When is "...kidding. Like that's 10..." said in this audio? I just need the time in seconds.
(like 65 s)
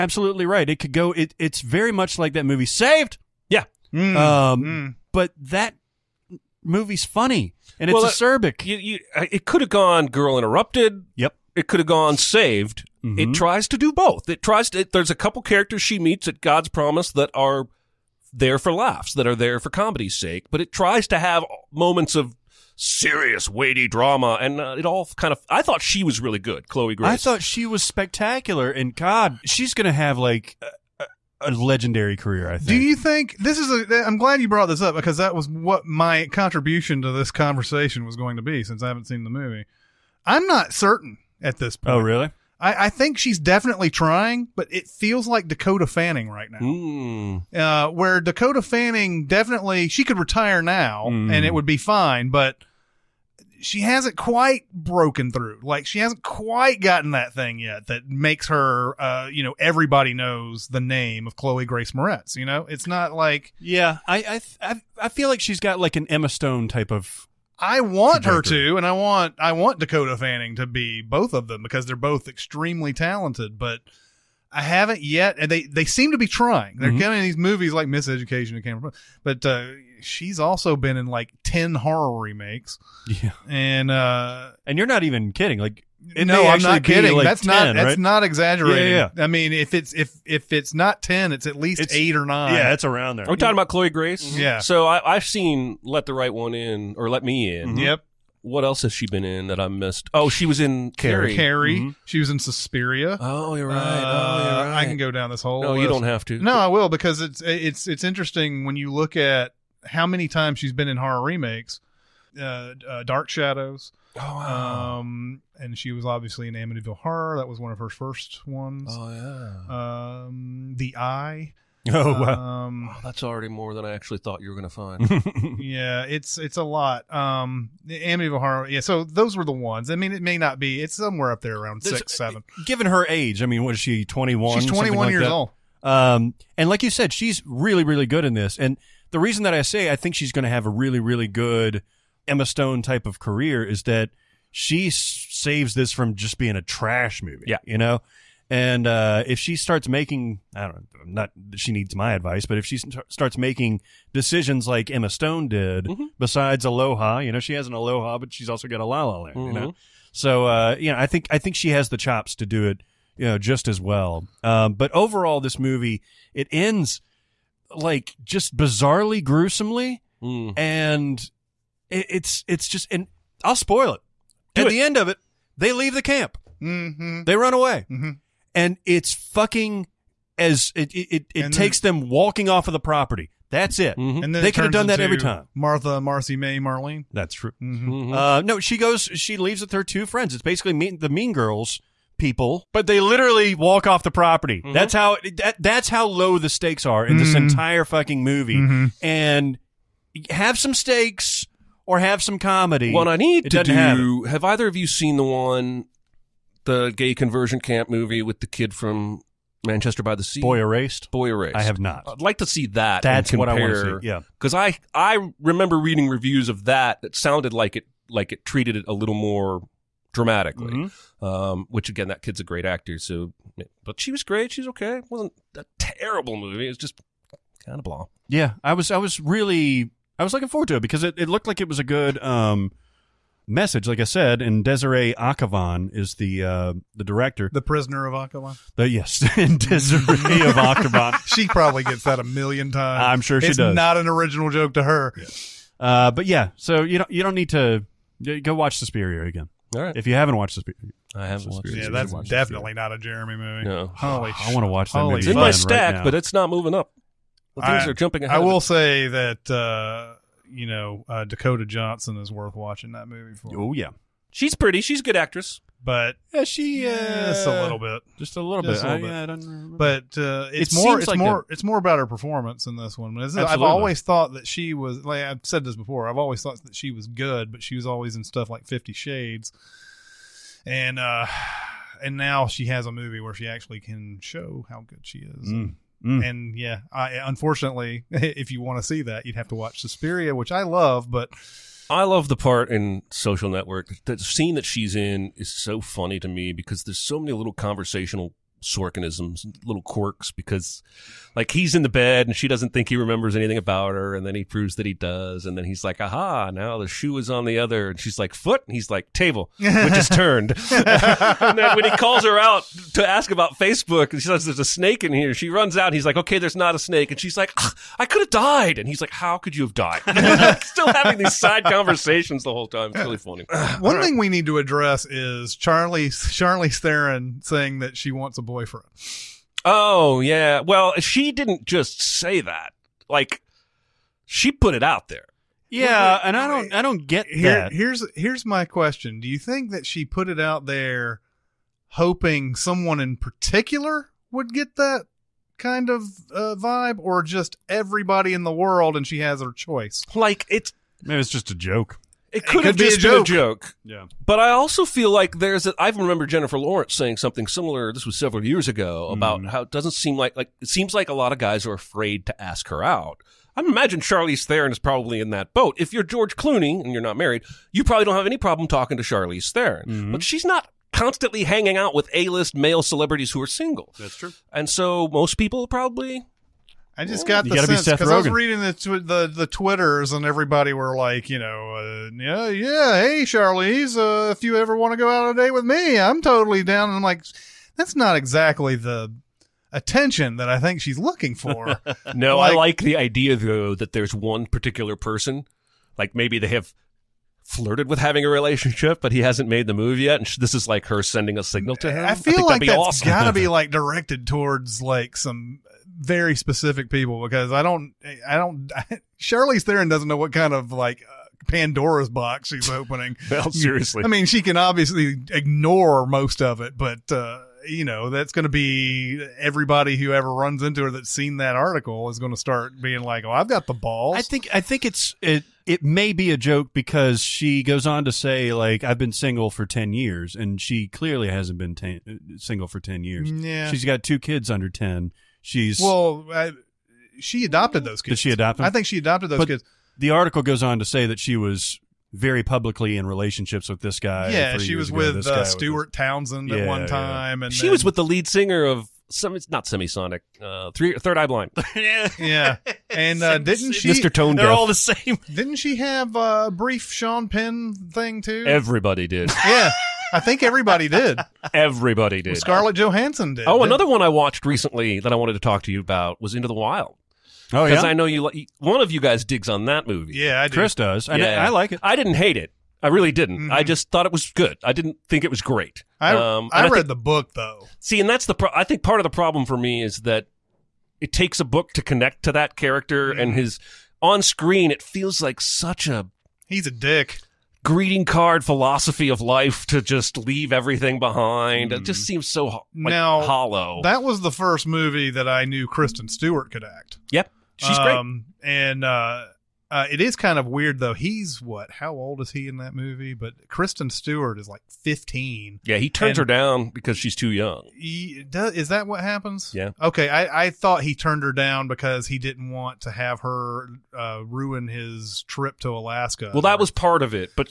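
86 s.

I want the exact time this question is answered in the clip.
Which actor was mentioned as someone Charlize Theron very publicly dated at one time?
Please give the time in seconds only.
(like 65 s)
445 s.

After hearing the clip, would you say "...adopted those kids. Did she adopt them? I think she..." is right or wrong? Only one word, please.
right.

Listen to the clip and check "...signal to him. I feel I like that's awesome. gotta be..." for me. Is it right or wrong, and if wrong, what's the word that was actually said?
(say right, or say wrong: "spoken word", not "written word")
right.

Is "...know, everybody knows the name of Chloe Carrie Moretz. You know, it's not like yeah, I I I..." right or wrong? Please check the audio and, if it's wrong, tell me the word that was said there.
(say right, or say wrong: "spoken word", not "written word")
wrong: "Grace", not "Carrie".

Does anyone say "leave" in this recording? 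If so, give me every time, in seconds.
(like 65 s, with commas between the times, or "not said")
175 s, 189 s, 490 s.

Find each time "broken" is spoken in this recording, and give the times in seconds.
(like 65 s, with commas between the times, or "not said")
54 s.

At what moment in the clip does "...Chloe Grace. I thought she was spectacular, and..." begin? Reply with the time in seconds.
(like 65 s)
26 s.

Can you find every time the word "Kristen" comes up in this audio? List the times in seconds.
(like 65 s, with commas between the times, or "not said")
495 s, 503 s.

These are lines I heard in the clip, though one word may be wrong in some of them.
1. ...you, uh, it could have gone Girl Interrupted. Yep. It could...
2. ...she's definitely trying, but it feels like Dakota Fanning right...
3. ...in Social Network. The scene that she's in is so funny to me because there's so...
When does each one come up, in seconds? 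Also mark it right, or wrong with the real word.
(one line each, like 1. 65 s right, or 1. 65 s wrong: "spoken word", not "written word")
1. 8 s right
2. 43 s right
3. 292 s right.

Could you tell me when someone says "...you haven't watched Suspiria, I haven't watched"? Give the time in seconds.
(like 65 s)
250 s.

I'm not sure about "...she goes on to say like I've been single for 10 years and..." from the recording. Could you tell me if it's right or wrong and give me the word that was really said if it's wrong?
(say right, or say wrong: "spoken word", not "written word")
right.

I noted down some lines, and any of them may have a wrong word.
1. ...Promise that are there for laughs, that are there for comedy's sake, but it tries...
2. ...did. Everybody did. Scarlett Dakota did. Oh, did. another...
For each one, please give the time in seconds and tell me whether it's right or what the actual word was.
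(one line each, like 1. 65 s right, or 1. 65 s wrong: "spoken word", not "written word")
1. 16 s right
2. 460 s wrong: "Johansson", not "Dakota".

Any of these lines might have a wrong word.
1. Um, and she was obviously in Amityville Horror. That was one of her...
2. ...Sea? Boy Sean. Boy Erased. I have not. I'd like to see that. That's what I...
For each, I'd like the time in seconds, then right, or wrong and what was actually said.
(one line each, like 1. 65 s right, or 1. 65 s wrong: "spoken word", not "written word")
1. 115 s right
2. 210 s wrong: "Erased", not "Sean".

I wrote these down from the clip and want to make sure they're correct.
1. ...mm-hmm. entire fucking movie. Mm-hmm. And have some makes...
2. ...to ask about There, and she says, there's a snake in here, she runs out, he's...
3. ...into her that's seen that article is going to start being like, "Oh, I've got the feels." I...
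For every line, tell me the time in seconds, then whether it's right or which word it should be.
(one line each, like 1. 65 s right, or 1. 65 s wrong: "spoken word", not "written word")
1. 197 s wrong: "stakes", not "makes"
2. 312 s wrong: "Facebook", not "There"
3. 420 s wrong: "balls", not "feels".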